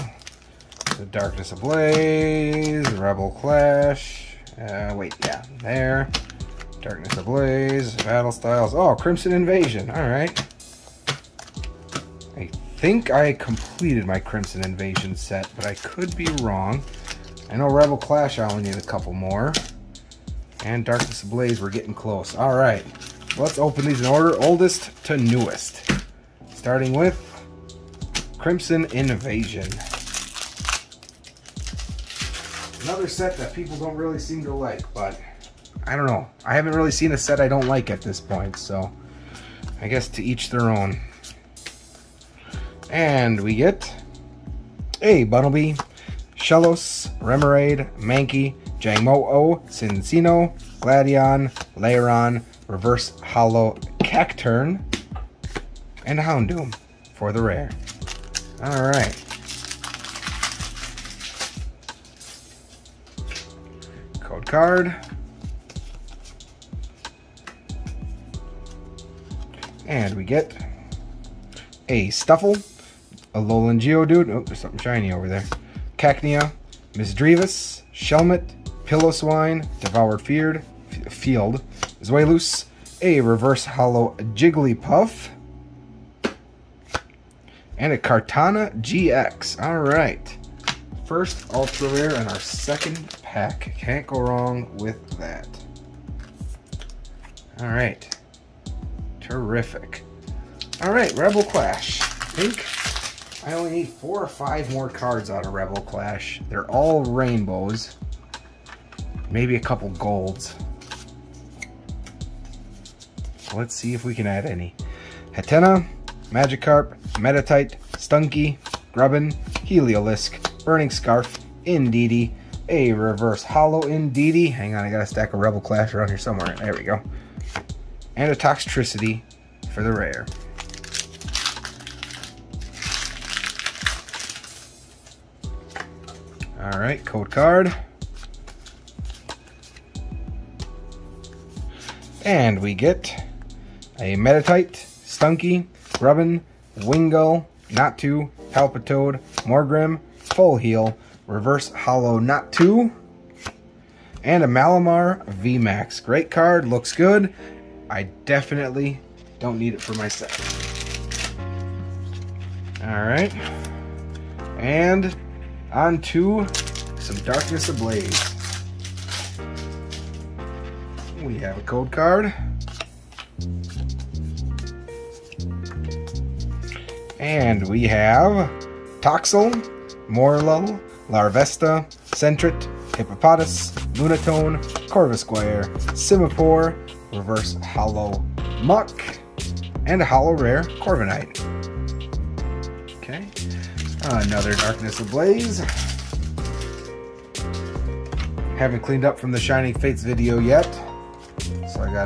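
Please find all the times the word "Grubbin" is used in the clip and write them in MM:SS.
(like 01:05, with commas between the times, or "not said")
01:58, 02:25.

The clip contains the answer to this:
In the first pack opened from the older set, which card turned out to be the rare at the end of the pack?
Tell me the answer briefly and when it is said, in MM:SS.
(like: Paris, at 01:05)
Houndoom, at 00:56.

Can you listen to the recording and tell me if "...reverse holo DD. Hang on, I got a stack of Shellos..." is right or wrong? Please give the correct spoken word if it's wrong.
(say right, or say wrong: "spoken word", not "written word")
wrong: "Rebel", not "Shellos".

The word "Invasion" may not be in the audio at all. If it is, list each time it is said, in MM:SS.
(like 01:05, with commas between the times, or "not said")
00:09, 00:14, 00:28.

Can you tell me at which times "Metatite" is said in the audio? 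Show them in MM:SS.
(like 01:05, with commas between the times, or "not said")
01:57, 02:24.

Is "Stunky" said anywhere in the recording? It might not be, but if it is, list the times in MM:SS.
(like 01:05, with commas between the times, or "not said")
01:57, 02:24.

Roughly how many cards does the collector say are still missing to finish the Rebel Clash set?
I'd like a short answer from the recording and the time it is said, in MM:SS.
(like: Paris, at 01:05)
4 or 5, at 01:43.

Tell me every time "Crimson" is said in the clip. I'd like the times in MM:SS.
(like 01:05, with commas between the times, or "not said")
00:08, 00:14, 00:28.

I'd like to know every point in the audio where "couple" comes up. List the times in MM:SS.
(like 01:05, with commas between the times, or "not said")
00:18, 01:49.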